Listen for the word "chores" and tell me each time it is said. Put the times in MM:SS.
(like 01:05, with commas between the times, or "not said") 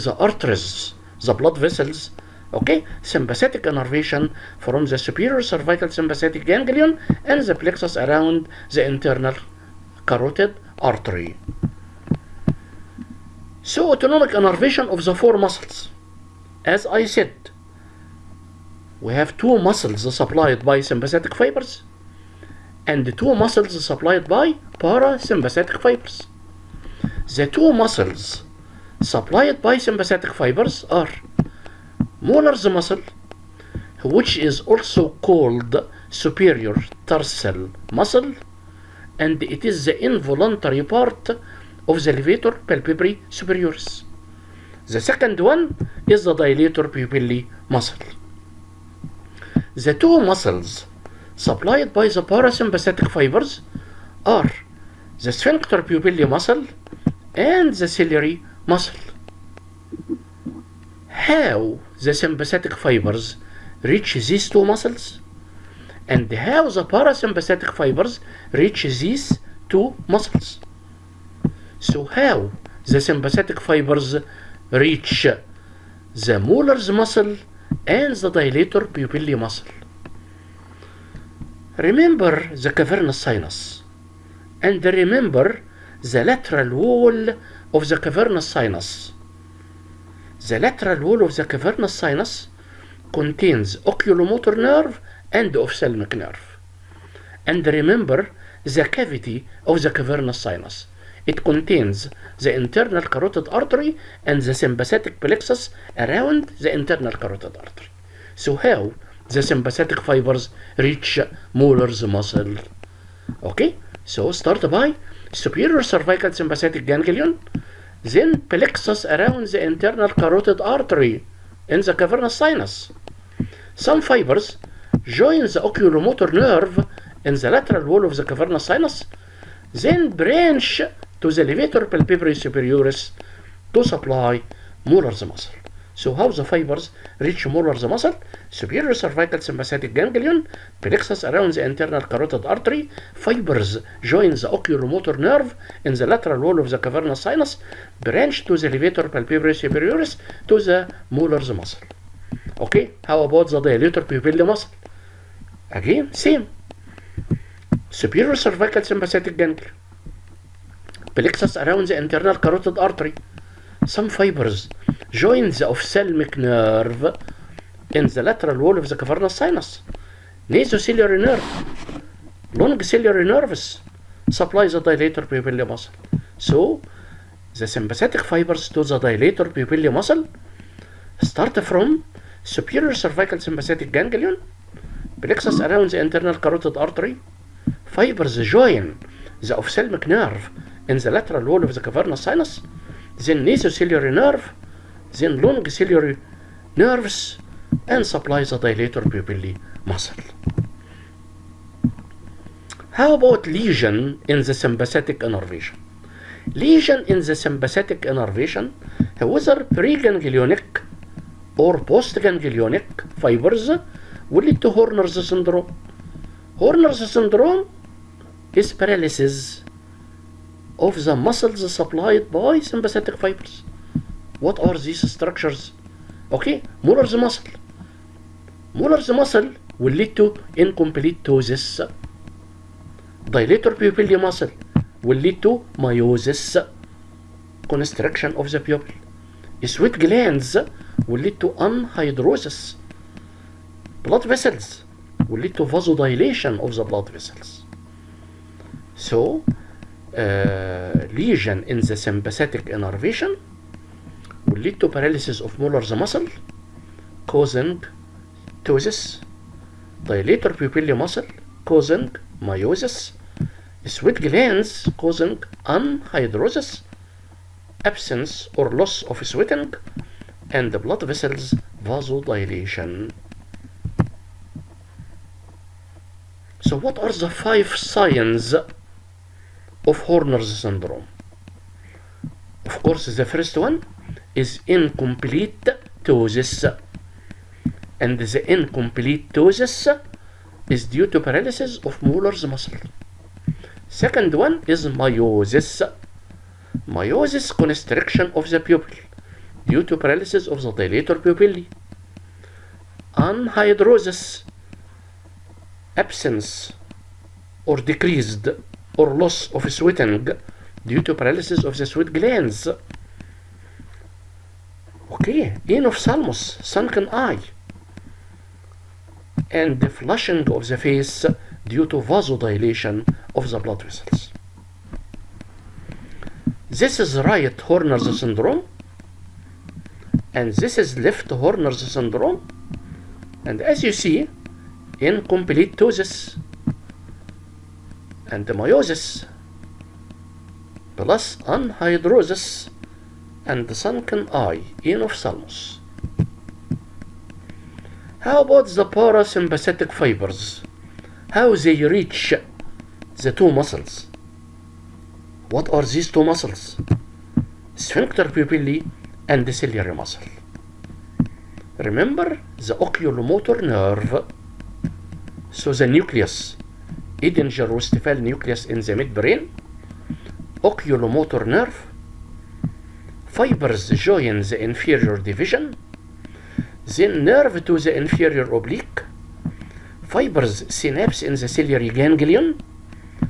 not said.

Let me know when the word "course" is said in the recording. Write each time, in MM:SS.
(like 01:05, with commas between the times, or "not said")
04:42.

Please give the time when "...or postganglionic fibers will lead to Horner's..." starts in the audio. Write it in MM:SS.
03:31.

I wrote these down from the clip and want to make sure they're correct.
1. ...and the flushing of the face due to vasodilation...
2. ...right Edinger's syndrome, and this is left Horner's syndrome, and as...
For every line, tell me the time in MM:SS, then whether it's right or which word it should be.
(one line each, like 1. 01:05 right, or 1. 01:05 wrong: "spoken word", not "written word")
1. 05:19 right
2. 05:27 wrong: "Horner", not "Edinger".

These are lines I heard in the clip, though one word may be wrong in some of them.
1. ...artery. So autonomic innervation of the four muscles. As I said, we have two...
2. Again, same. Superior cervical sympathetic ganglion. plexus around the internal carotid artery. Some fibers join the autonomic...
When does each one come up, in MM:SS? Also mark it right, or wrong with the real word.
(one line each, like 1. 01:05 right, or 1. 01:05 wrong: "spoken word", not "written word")
1. 00:10 right
2. 02:35 wrong: "ophthalmic", not "autonomic".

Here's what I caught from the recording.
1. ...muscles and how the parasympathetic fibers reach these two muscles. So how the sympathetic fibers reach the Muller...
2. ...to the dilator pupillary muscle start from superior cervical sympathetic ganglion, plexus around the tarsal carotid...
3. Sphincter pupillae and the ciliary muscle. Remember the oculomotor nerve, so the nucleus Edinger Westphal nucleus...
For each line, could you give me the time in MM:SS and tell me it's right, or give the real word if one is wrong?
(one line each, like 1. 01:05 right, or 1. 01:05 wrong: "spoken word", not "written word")
1. 01:04 right
2. 02:58 wrong: "internal", not "tarsal"
3. 05:57 right.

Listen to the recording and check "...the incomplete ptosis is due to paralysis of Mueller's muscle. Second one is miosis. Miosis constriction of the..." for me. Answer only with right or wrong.
right.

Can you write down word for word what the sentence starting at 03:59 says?
Sweat glands will lead to anhidrosis.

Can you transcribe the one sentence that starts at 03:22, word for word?
How about lesion in the sympathetic innervation?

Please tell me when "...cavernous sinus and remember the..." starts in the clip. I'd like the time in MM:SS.
01:22.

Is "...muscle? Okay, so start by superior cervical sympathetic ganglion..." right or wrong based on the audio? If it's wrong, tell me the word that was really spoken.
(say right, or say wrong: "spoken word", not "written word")
right.